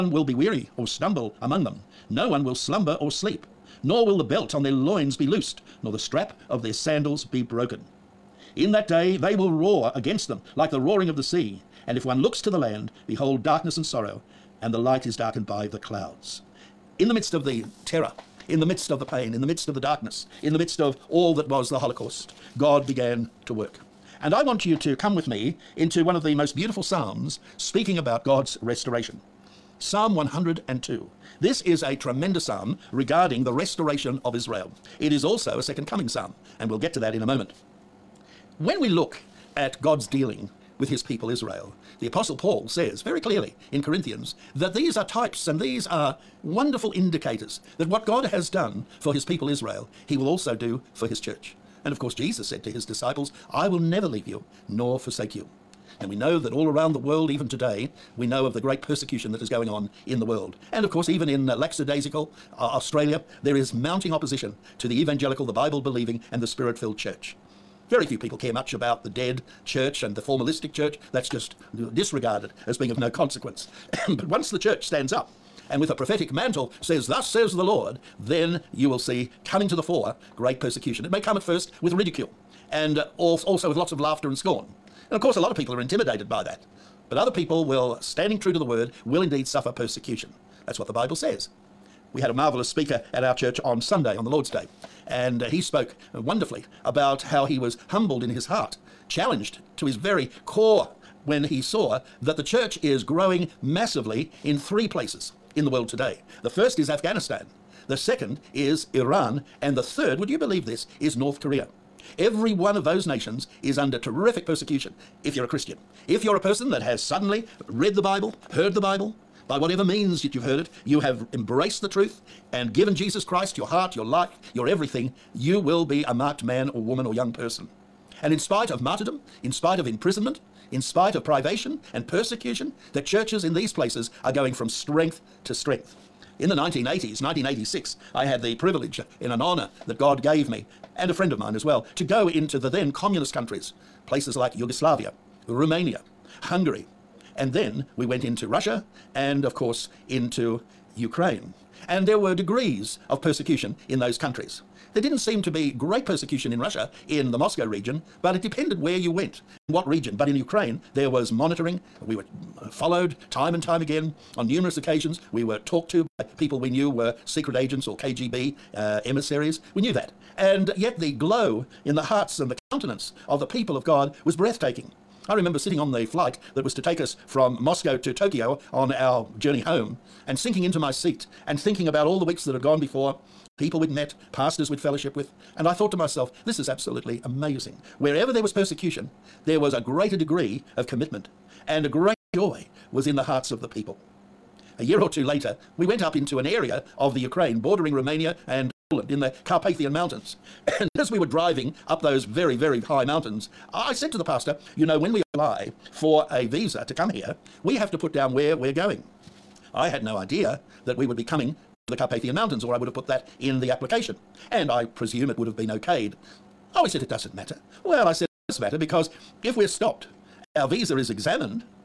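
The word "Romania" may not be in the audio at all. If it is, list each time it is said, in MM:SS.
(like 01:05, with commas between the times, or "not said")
02:25, 03:17.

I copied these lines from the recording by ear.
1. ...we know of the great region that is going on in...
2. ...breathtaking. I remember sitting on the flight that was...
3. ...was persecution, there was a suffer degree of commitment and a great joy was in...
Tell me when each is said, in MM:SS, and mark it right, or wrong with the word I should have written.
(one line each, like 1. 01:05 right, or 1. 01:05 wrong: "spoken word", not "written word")
1. 00:58 wrong: "persecution", not "region"
2. 02:54 right
3. 03:08 wrong: "greater", not "suffer".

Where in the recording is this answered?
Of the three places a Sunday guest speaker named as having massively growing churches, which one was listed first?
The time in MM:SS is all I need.
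01:46.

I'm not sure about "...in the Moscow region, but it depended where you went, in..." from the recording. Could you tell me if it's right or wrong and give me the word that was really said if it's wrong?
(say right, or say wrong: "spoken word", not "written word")
right.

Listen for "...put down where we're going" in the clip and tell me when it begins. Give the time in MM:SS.
03:27.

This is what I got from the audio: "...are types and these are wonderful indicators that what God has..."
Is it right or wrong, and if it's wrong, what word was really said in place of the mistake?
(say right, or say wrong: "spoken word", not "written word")
right.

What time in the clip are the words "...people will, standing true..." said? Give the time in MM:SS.
01:27.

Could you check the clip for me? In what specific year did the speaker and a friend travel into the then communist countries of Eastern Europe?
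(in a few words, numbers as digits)
1986.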